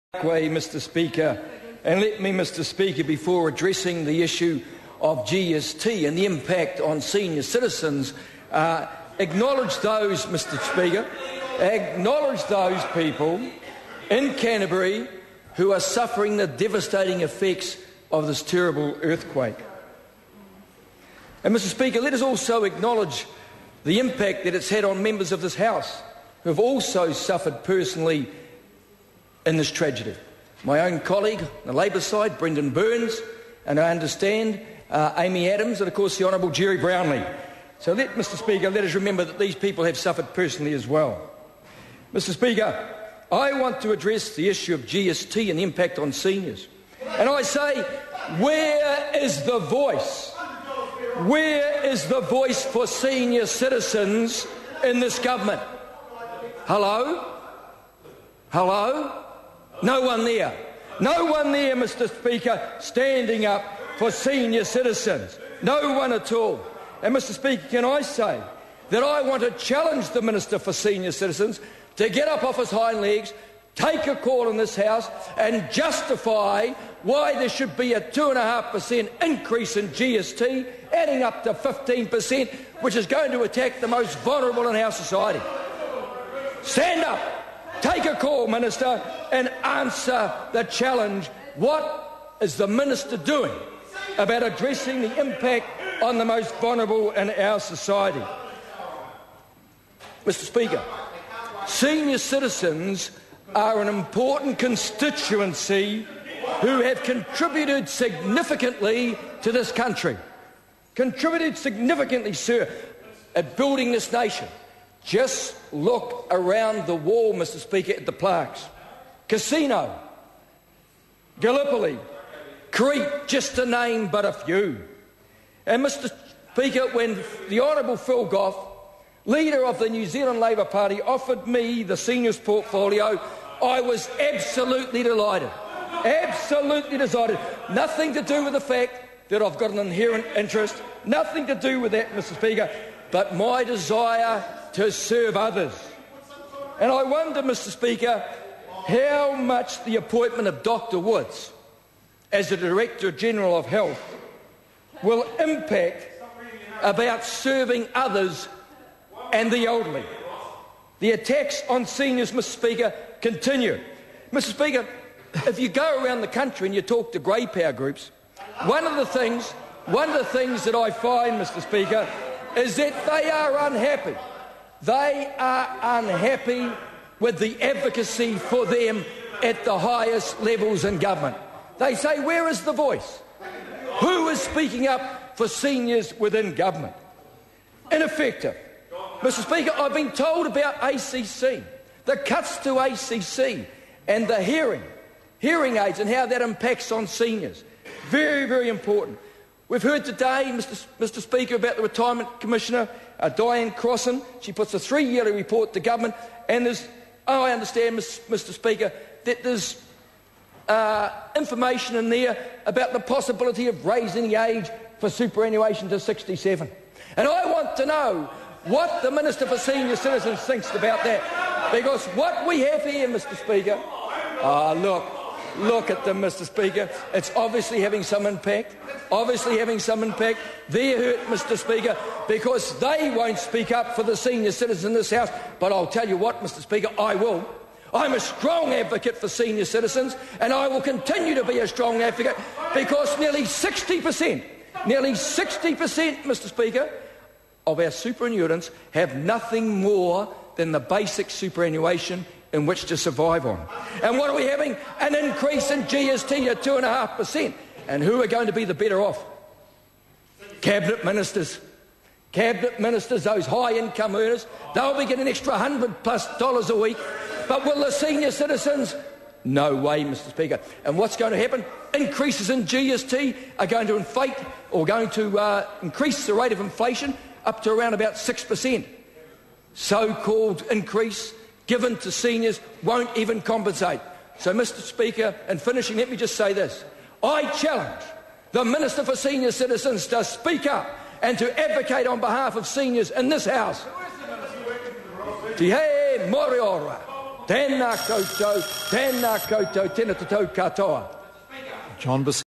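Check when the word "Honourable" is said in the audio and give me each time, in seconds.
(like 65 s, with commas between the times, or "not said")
36 s, 127 s.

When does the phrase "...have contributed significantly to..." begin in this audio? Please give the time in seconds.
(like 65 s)
106 s.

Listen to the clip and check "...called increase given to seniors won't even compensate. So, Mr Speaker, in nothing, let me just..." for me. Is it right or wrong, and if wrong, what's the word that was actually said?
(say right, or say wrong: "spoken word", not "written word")
wrong: "finishing", not "nothing".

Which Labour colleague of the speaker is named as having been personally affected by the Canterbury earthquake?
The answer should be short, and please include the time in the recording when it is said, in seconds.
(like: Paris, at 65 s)
Brendan Burns, at 32 s.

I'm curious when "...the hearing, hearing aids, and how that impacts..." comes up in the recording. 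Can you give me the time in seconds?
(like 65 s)
194 s.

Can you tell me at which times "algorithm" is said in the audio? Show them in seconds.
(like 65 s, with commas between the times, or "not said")
not said.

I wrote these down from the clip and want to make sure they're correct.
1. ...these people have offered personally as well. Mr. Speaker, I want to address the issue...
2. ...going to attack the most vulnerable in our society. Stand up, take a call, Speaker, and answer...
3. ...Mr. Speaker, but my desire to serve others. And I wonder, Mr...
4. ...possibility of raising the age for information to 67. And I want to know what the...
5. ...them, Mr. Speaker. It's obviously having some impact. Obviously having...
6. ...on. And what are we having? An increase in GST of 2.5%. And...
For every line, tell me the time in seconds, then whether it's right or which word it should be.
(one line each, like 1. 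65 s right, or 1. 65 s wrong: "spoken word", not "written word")
1. 39 s wrong: "suffered", not "offered"
2. 83 s wrong: "Minister", not "Speaker"
3. 142 s right
4. 212 s wrong: "superannuation", not "information"
5. 226 s right
6. 253 s right.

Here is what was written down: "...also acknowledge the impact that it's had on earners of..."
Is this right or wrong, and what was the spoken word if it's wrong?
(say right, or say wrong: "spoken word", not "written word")
wrong: "members", not "earners".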